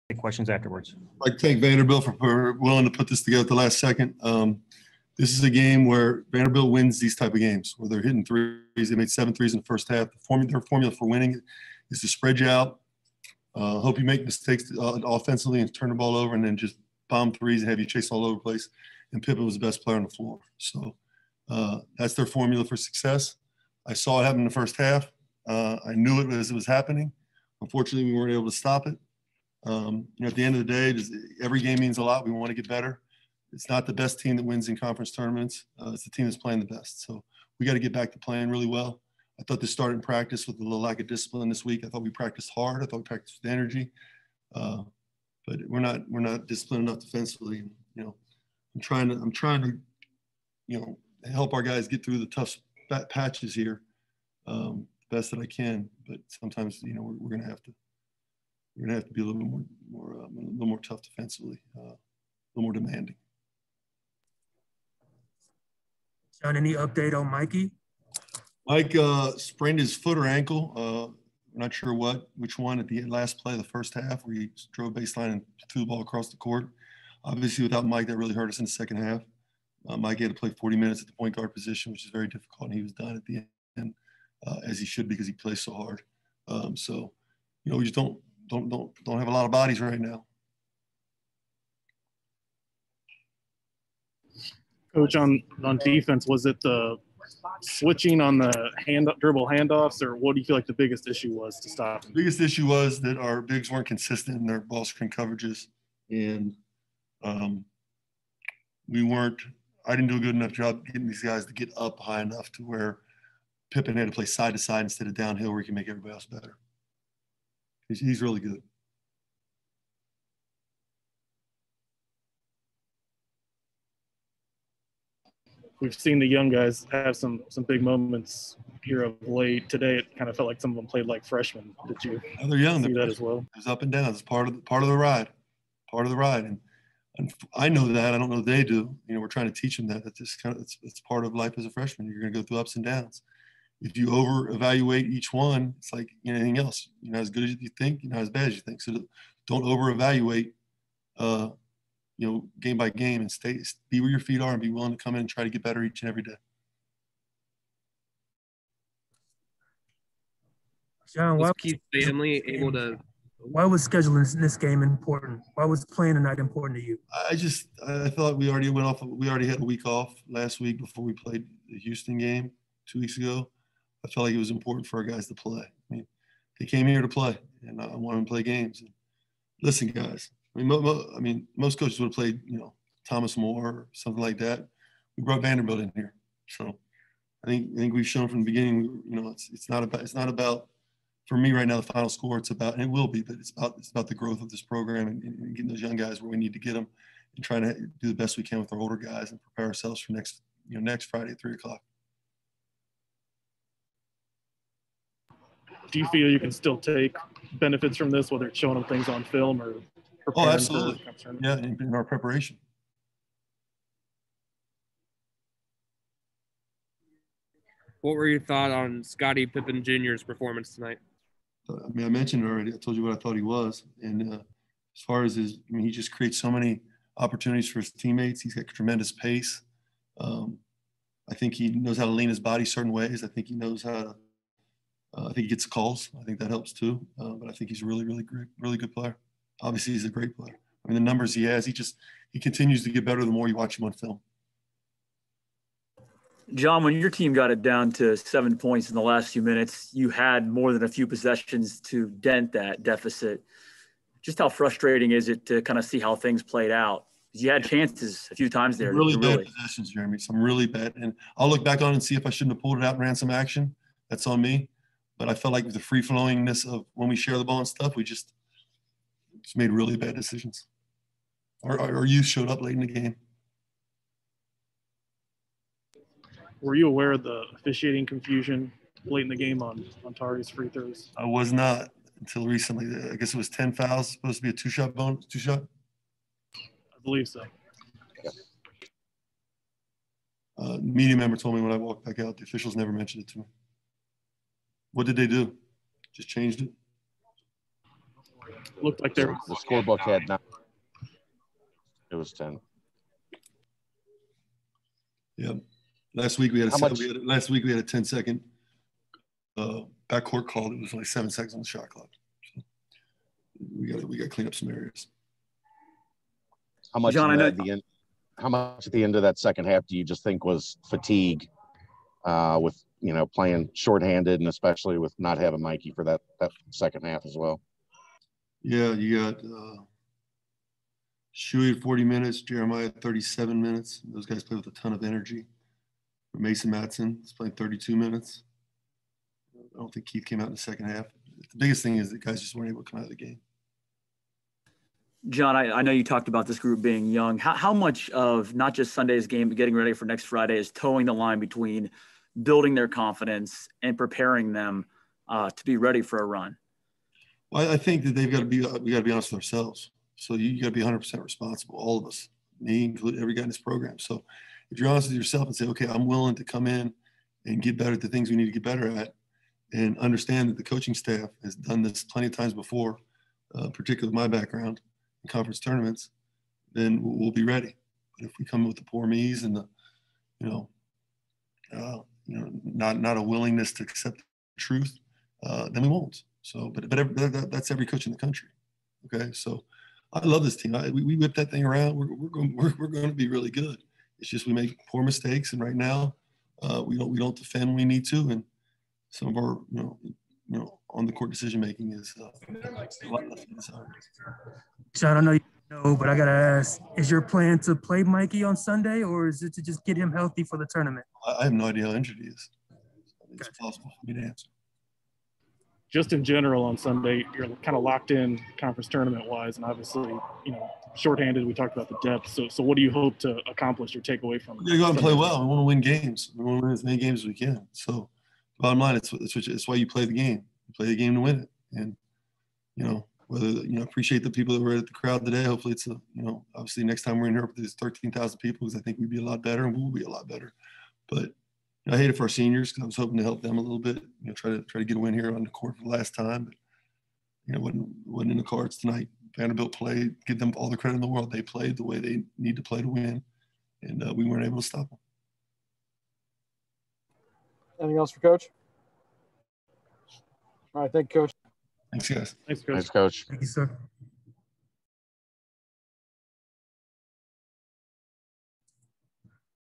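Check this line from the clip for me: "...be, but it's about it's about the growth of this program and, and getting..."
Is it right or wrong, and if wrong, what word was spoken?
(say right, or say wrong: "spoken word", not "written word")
right.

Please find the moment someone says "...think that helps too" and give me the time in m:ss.
3:56.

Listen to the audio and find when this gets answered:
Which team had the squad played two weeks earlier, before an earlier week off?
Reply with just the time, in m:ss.
2:51.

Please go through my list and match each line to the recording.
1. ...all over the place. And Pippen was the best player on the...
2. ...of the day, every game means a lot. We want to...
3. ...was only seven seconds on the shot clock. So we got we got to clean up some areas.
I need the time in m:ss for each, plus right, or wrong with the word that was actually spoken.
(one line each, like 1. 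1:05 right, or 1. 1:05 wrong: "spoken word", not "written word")
1. 0:18 right
2. 0:30 right
3. 5:10 right.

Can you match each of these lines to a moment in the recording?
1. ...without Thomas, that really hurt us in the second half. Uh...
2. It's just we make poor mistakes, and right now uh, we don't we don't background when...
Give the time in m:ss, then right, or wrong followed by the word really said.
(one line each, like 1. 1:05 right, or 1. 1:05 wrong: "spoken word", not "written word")
1. 1:17 wrong: "Mike", not "Thomas"
2. 6:34 wrong: "defend", not "background".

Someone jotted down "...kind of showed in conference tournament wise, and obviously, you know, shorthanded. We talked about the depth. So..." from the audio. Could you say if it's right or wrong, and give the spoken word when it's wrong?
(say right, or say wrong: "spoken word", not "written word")
wrong: "locked", not "showed".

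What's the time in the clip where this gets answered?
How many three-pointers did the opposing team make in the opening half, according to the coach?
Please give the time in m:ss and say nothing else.
0:09.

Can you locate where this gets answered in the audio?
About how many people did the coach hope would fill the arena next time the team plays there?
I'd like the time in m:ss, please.
7:17.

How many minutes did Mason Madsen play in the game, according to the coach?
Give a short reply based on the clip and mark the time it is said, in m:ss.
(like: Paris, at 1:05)
32, at 5:37.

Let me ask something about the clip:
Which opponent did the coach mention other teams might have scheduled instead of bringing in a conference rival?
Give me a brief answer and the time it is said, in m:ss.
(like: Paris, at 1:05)
Thomas More, at 3:03.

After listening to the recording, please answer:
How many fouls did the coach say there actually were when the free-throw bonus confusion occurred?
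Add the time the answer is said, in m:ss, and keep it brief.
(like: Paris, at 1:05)
10, at 4:43.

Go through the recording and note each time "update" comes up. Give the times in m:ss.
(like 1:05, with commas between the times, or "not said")
1:06.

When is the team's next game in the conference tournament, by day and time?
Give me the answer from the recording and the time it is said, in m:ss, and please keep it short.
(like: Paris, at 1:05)
Friday at 3 o'clock, at 3:21.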